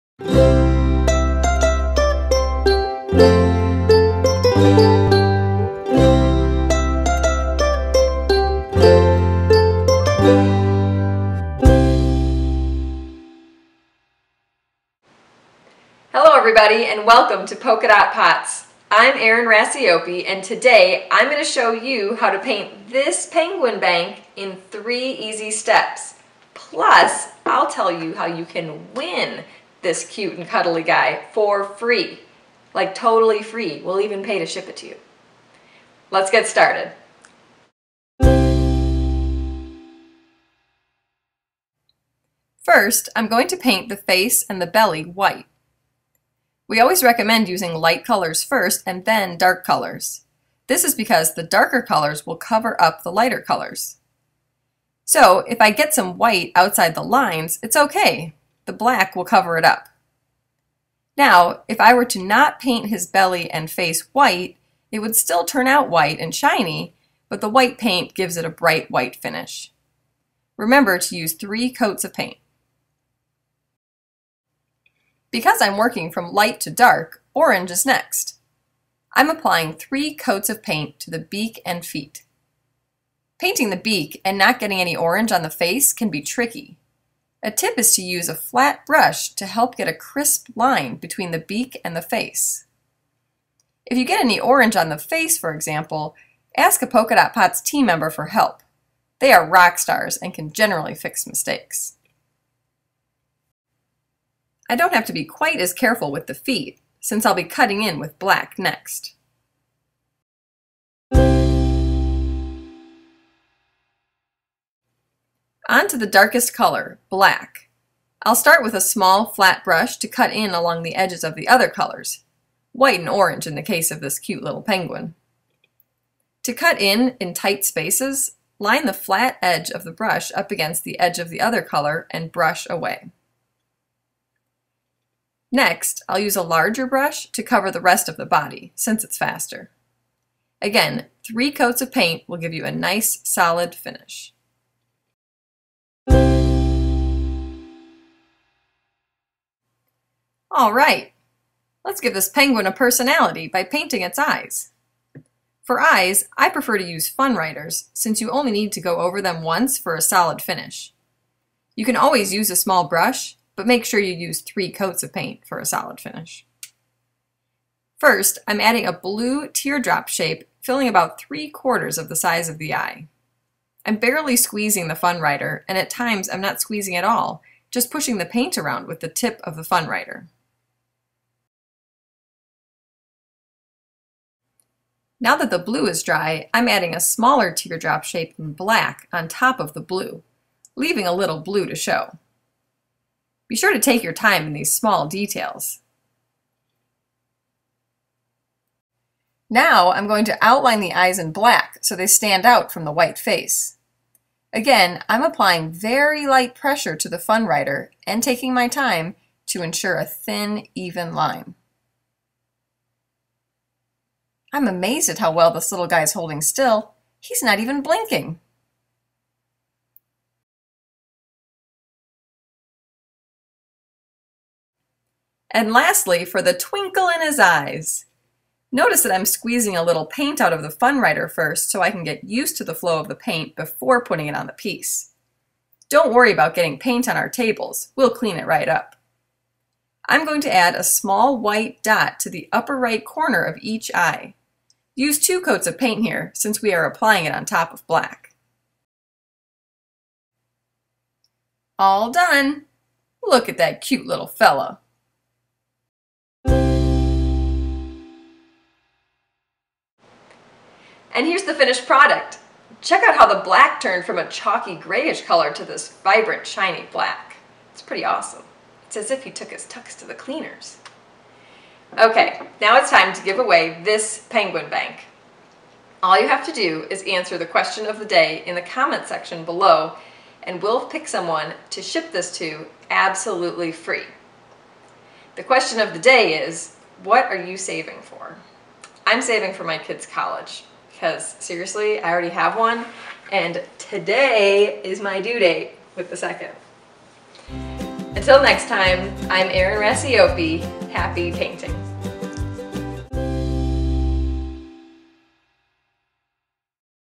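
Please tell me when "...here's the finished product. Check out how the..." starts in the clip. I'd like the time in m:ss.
4:21.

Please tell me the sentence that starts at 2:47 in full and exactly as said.
First, I'm adding a blue teardrop shape, filling about three quarters of the size of the eye.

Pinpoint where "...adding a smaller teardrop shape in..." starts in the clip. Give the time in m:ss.
3:06.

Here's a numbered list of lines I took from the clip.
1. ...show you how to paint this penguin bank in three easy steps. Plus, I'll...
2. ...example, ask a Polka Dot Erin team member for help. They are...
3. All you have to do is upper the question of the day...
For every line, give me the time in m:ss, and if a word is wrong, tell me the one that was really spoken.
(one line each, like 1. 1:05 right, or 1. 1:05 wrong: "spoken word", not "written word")
1. 0:21 right
2. 1:35 wrong: "Pots", not "Erin"
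3. 4:36 wrong: "answer", not "upper".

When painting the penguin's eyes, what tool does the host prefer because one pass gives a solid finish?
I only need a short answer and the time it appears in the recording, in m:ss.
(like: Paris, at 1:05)
Fun writers, at 2:37.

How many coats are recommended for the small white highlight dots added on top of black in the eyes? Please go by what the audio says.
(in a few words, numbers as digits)
2.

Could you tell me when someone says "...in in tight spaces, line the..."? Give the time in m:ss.
2:06.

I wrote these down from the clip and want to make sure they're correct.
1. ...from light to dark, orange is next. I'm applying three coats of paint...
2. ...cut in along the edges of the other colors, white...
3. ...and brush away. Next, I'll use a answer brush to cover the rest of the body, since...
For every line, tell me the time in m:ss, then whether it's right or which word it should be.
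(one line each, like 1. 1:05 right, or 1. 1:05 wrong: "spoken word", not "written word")
1. 1:16 right
2. 2:00 right
3. 2:12 wrong: "larger", not "answer".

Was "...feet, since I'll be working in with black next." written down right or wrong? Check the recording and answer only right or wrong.
wrong.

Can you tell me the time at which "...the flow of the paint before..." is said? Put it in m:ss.
3:52.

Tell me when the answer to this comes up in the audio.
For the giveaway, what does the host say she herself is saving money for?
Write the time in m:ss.
4:49.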